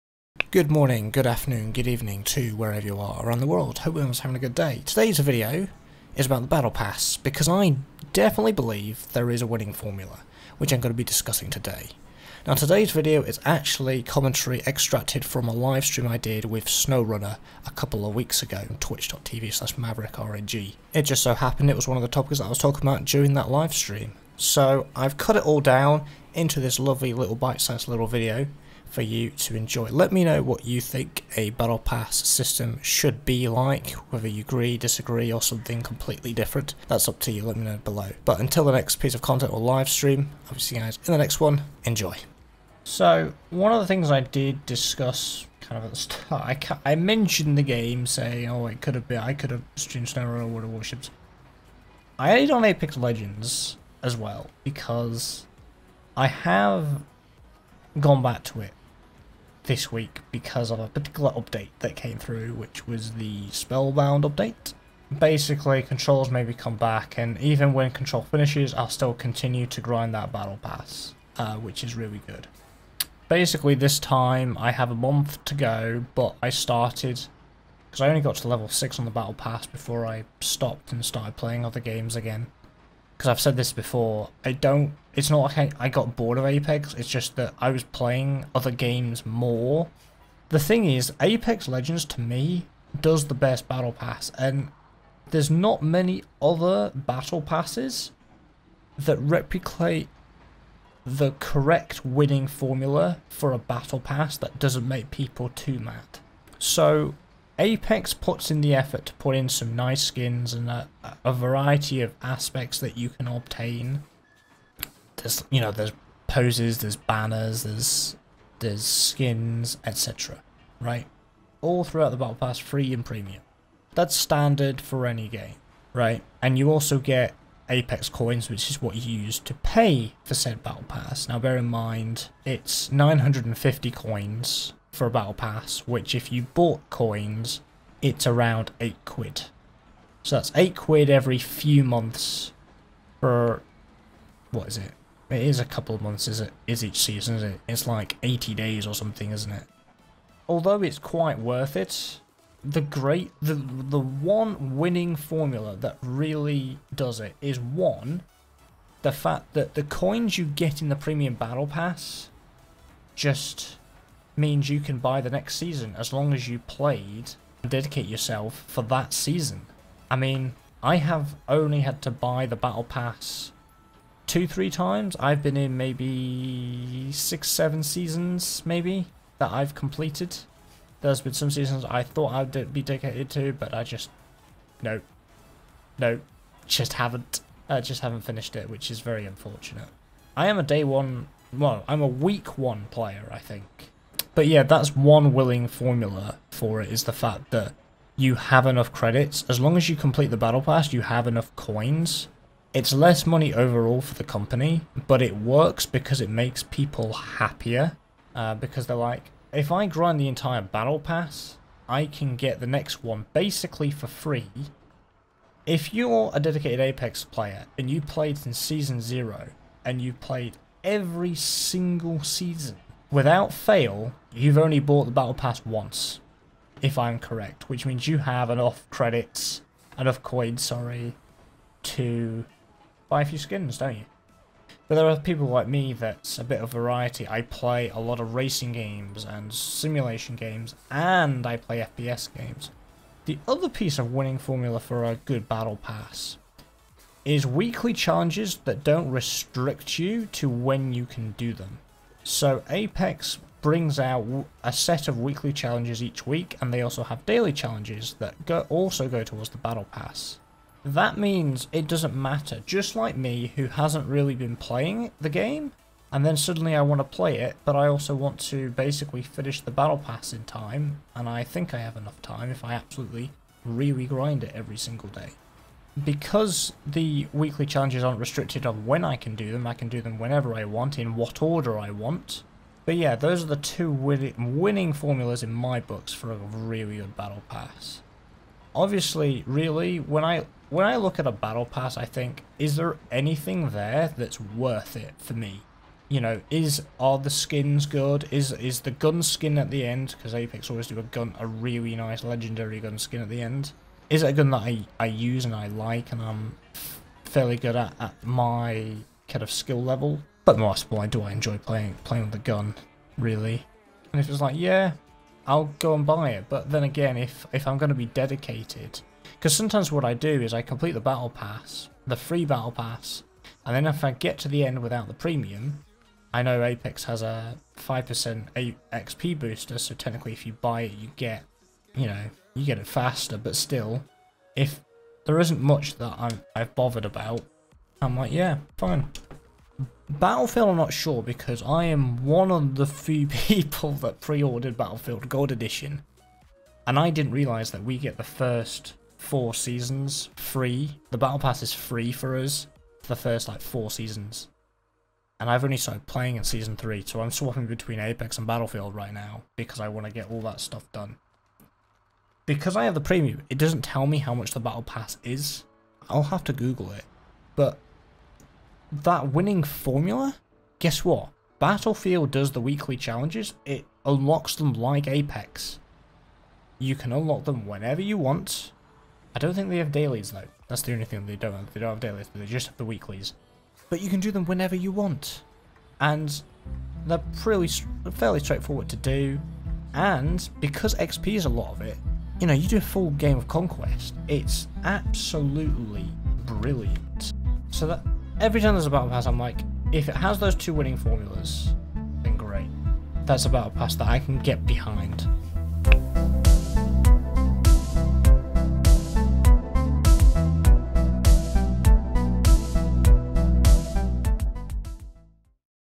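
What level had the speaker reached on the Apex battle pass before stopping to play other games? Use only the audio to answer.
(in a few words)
6.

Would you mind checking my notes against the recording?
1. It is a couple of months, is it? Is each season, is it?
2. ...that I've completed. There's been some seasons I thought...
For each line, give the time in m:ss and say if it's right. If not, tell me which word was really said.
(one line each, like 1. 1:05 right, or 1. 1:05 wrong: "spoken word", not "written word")
1. 2:25 right
2. 2:59 right.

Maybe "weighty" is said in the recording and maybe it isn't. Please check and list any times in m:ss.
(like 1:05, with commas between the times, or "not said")
not said.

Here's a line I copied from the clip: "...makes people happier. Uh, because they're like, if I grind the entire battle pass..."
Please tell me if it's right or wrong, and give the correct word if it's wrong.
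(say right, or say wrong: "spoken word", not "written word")
right.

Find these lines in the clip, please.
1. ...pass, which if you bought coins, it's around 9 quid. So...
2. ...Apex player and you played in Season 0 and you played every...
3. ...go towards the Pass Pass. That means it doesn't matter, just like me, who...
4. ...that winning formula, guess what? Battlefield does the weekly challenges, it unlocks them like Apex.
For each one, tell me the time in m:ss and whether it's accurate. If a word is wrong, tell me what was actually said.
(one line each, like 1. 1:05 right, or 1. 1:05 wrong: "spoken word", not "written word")
1. 2:15 wrong: "8", not "9"
2. 3:36 right
3. 4:19 wrong: "Battle", not "Pass"
4. 6:08 right.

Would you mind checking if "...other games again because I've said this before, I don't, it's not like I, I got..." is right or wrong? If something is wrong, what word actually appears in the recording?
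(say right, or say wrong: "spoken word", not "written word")
right.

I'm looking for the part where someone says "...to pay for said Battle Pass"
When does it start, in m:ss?
2:09.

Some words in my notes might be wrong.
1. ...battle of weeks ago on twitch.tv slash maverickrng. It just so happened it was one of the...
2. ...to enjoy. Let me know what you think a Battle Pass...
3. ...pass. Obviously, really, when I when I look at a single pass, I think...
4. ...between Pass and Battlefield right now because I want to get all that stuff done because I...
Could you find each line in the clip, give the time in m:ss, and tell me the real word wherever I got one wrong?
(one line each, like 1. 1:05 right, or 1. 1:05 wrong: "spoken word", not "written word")
1. 0:17 wrong: "couple", not "battle"
2. 0:29 right
3. 4:47 wrong: "battle", not "single"
4. 5:57 wrong: "Apex", not "Pass".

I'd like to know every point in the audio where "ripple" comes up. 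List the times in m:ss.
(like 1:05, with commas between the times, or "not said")
not said.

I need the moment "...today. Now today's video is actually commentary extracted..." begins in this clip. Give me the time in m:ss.
0:11.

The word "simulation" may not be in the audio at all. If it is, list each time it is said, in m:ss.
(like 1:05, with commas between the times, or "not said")
3:59.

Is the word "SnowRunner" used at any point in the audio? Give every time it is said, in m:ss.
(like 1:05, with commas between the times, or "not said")
0:16, 0:50.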